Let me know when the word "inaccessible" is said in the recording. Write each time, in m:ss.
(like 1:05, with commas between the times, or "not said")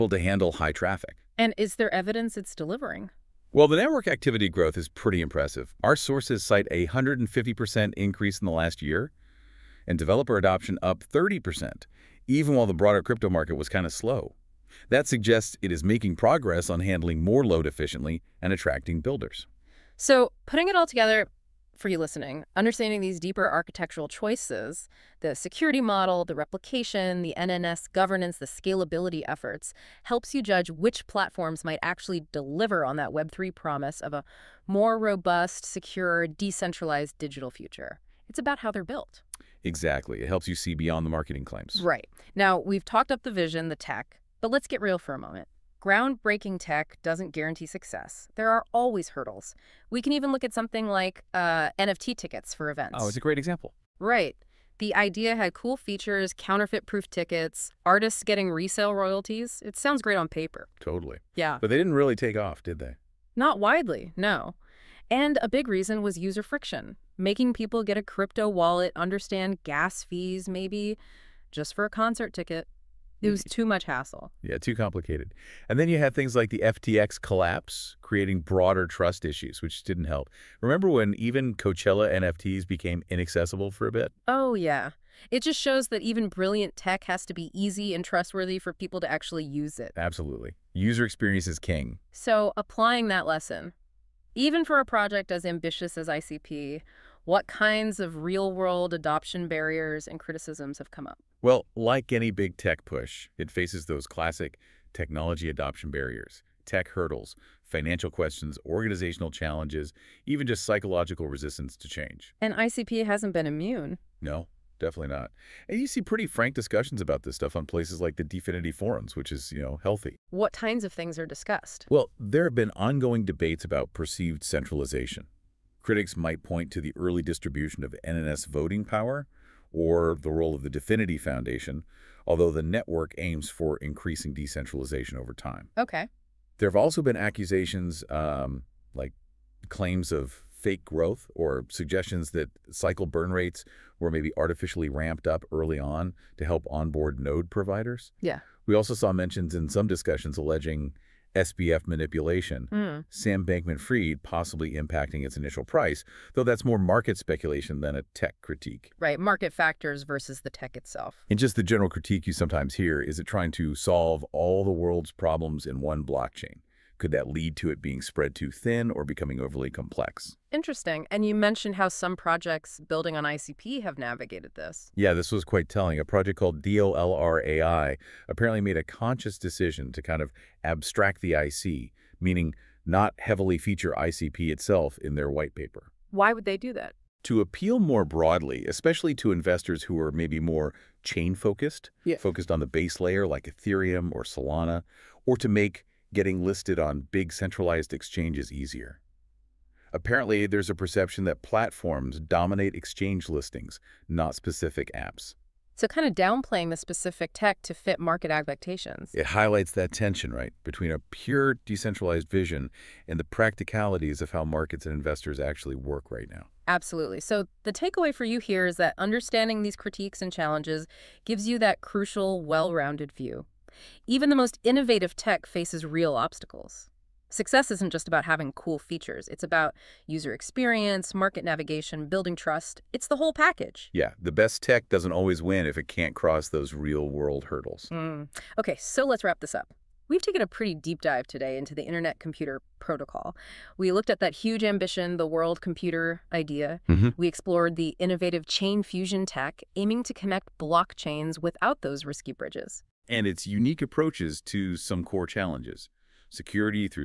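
1:23.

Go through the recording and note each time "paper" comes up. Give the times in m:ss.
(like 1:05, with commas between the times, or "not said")
1:00, 3:05.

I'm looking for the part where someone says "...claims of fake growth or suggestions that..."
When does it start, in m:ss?
2:19.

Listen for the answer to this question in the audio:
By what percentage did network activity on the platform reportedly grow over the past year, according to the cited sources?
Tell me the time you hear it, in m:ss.
0:06.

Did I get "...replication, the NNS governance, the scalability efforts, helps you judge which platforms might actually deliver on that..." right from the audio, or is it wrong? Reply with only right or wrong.
right.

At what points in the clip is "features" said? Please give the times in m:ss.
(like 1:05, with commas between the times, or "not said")
0:55, 3:03, 3:48.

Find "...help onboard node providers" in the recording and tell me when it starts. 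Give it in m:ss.
2:26.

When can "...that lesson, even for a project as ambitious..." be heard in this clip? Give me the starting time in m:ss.
1:33.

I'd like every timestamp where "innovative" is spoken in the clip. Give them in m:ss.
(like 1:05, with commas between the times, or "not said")
3:44, 4:07.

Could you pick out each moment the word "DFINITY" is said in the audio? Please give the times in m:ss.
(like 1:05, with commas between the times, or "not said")
1:58, 2:10.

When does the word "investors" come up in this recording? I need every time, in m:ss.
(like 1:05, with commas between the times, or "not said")
3:09, 3:34.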